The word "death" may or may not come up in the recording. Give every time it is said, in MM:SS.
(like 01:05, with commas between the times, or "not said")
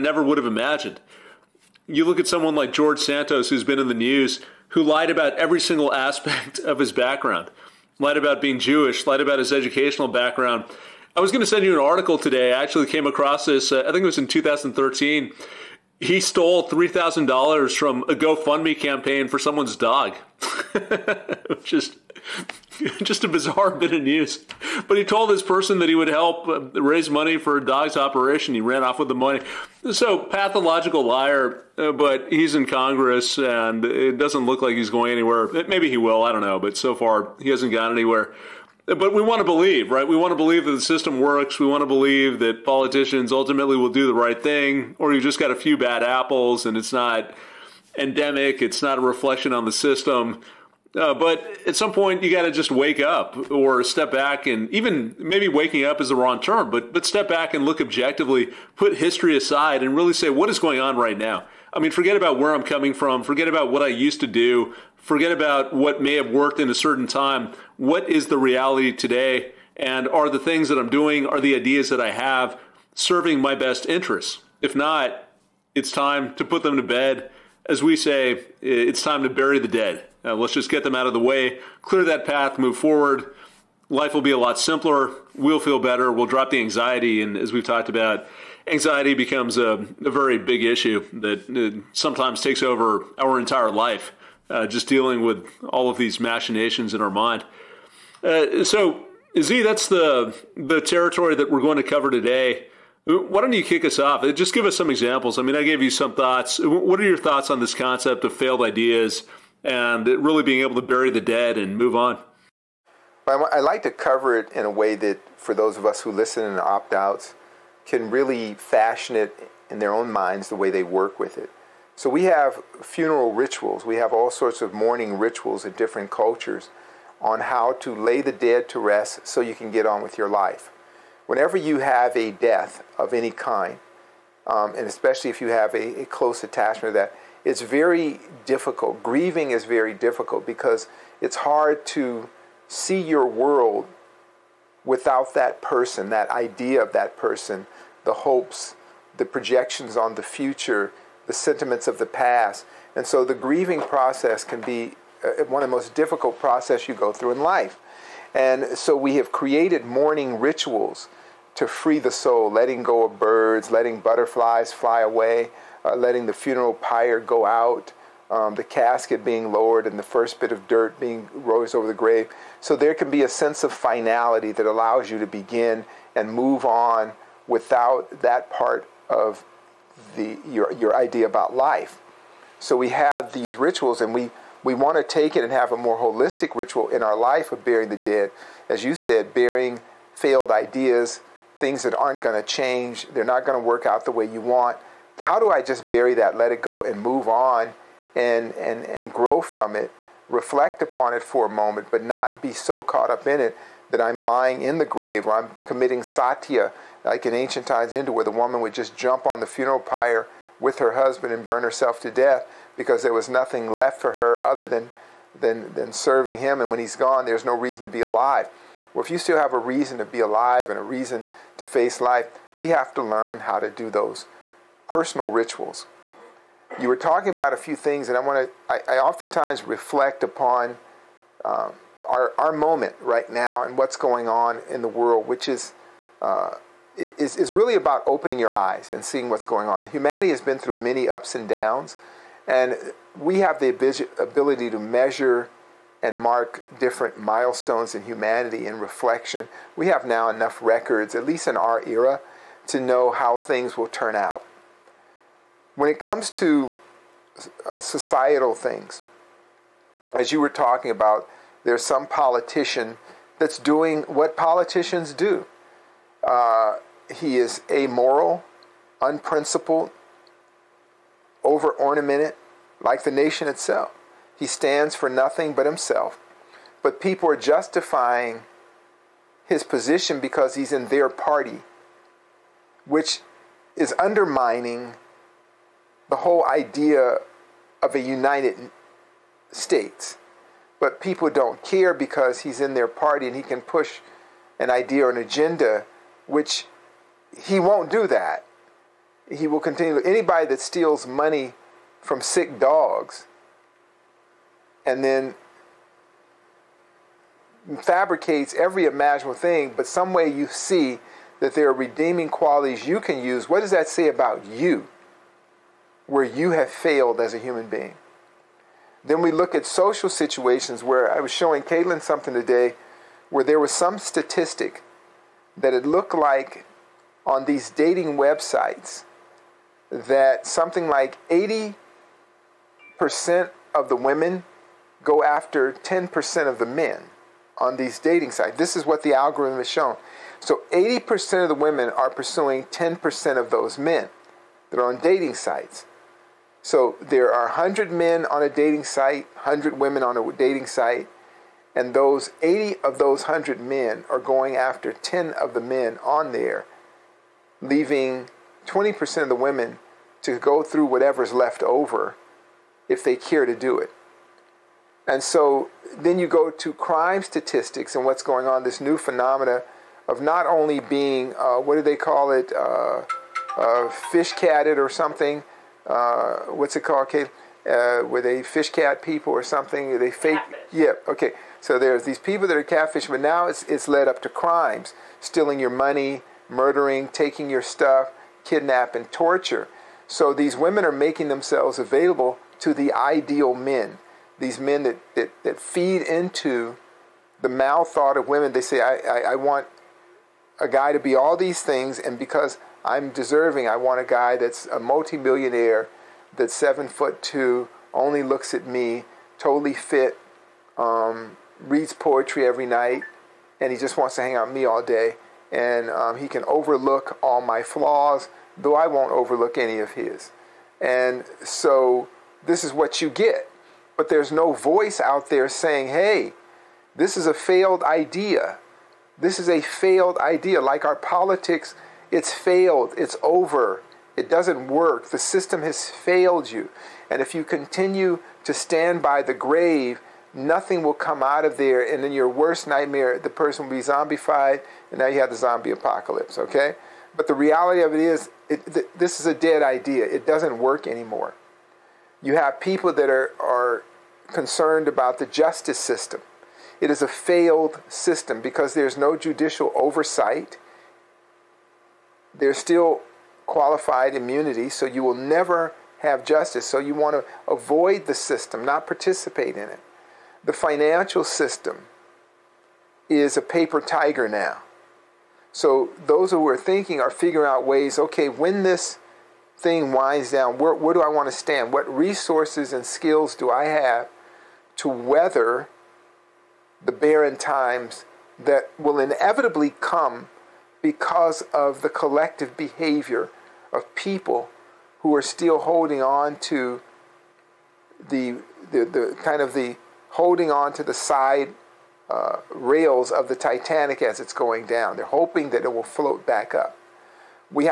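02:12, 03:32.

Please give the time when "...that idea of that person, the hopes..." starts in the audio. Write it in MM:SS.
02:26.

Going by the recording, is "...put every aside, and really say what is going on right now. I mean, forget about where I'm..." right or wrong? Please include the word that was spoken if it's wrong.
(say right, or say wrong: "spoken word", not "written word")
wrong: "history", not "every".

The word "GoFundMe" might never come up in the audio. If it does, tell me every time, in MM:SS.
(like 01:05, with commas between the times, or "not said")
00:18.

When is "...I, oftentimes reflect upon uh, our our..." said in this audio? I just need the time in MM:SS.
03:48.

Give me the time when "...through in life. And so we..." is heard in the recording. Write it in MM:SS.
02:37.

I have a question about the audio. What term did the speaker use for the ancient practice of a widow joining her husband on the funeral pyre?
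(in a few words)
satya.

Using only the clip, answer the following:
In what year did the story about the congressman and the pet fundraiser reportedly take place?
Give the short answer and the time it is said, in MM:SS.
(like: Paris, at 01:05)
2013, at 00:14.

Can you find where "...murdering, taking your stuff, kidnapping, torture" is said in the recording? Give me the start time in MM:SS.
06:26.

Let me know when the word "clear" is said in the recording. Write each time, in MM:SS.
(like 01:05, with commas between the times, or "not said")
01:21.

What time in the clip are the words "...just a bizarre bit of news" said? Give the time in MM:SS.
00:23.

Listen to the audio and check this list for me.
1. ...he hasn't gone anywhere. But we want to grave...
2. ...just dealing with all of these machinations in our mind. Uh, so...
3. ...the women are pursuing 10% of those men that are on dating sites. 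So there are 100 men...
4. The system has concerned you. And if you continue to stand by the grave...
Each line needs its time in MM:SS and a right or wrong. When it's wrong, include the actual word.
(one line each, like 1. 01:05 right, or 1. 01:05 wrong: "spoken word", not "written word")
1. 00:37 wrong: "believe", not "grave"
2. 01:34 right
3. 05:41 right
4. 07:15 wrong: "failed", not "concerned".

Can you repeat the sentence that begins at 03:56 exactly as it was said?
Uh, is, is really about opening your eyes and seeing what's going on.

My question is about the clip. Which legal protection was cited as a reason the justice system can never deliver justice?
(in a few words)
qualified immunity.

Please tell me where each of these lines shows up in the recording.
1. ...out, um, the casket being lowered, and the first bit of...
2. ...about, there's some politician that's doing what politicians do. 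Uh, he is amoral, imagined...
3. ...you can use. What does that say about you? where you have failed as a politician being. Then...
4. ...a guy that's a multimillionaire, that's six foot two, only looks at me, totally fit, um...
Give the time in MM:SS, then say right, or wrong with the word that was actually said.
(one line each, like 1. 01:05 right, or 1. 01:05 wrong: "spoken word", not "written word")
1. 02:47 right
2. 04:20 wrong: "unprincipled", not "imagined"
3. 05:12 wrong: "human", not "politician"
4. 06:43 wrong: "seven", not "six".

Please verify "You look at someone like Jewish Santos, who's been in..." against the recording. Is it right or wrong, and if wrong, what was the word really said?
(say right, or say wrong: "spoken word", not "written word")
wrong: "George", not "Jewish".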